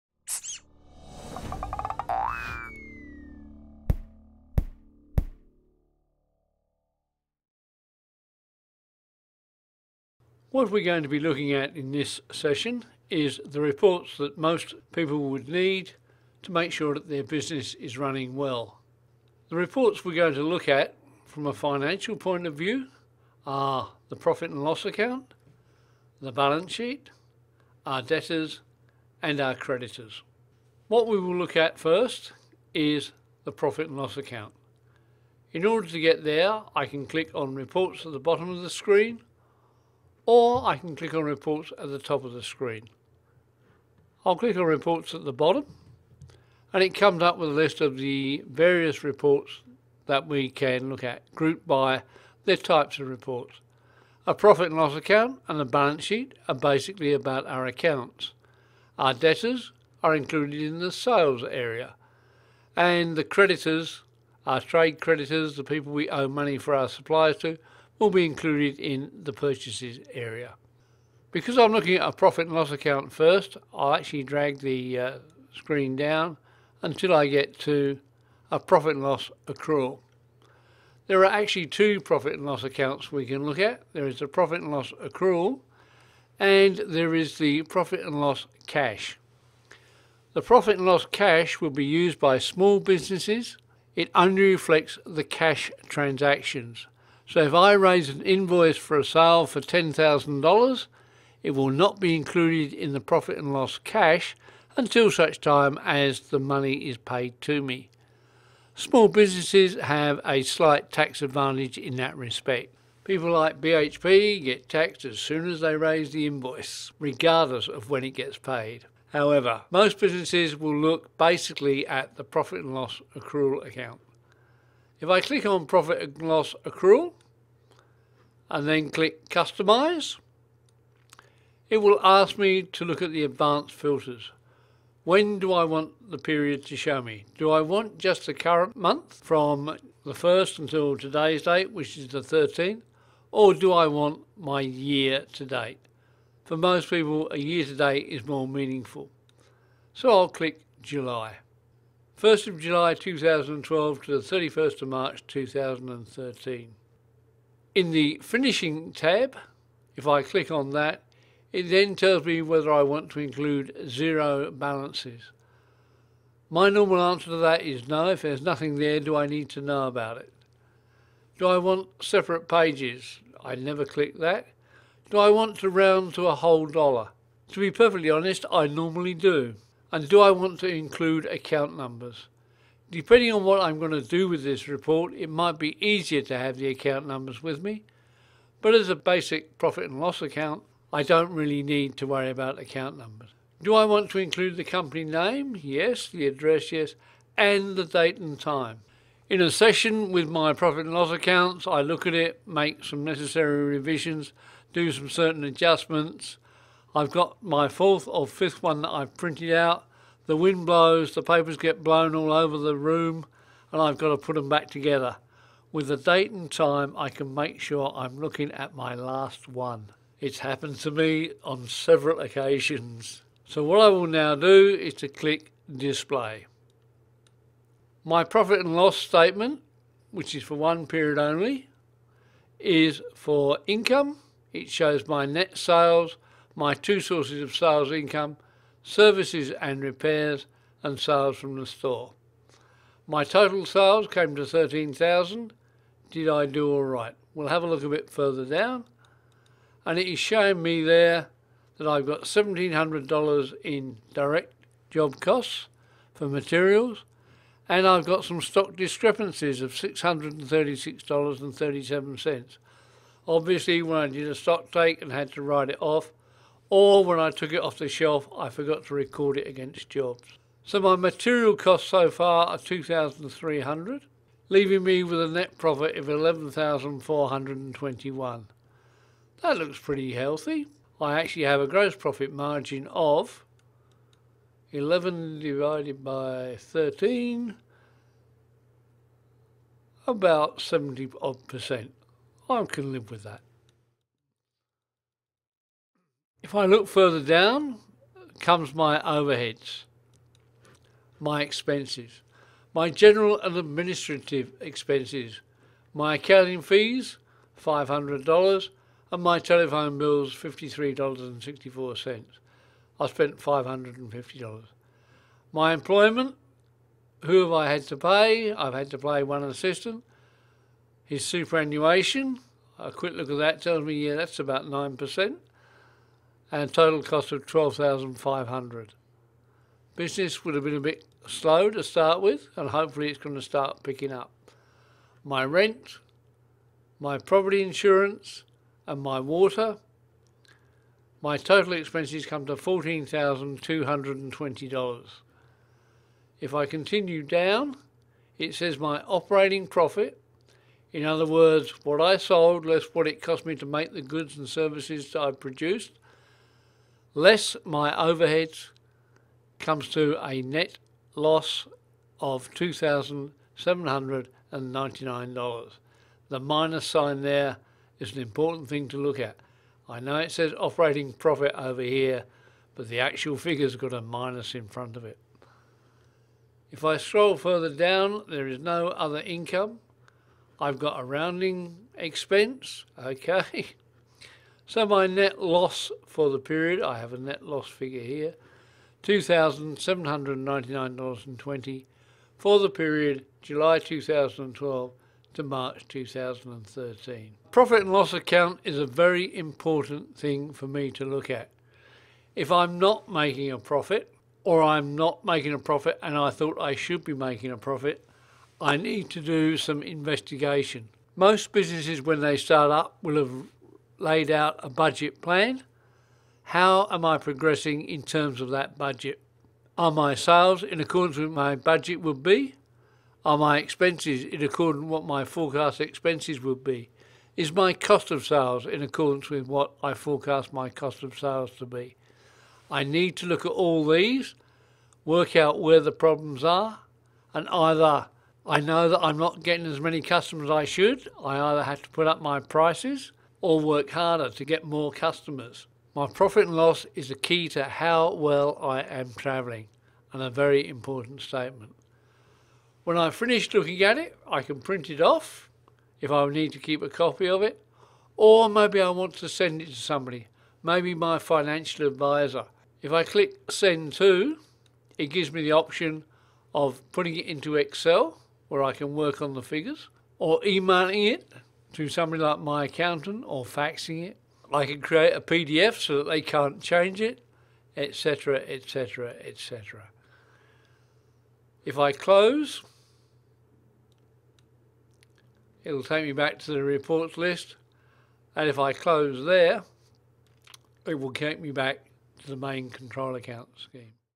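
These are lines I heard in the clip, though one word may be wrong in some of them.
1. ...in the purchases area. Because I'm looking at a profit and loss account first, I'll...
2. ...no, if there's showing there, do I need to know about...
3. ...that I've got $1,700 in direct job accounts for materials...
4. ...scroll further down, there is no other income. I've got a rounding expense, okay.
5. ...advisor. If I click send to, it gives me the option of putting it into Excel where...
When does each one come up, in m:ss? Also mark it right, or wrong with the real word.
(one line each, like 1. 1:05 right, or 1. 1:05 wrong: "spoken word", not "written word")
1. 1:08 right
2. 2:47 wrong: "nothing", not "showing"
3. 4:11 wrong: "costs", not "accounts"
4. 6:16 right
5. 7:41 right.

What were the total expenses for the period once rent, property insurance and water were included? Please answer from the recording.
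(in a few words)
$14,220.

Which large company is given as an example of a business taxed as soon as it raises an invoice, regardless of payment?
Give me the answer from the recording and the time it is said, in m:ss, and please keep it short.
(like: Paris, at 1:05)
BHP, at 1:53.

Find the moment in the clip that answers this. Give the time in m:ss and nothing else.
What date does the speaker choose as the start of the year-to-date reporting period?
2:32.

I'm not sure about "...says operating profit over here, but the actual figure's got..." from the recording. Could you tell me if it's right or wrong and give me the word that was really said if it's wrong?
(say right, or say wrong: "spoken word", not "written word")
right.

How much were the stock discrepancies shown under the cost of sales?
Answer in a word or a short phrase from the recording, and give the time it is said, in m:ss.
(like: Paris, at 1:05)
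$636.37, at 4:19.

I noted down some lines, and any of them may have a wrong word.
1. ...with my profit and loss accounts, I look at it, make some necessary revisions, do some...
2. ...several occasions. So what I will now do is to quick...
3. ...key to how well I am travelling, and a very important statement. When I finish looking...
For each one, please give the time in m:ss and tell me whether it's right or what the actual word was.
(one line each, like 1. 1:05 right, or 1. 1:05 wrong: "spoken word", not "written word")
1. 3:20 right
2. 3:41 wrong: "click", not "quick"
3. 7:27 right.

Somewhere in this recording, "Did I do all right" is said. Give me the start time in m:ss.
4:06.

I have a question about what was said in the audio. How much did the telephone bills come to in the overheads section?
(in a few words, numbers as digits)
$53.64.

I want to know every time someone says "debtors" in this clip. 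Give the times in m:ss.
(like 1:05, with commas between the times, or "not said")
0:28, 0:59.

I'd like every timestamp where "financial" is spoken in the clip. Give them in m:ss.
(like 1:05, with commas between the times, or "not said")
0:21, 7:41.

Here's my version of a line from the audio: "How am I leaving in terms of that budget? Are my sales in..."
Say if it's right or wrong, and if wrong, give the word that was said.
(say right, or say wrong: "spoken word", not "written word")
wrong: "progressing", not "leaving".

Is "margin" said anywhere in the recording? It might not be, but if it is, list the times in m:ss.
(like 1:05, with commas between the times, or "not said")
4:42.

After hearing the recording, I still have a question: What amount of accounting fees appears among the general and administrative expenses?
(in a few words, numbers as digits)
$500.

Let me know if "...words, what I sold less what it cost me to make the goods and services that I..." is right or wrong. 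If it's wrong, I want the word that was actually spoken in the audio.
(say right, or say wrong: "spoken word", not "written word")
right.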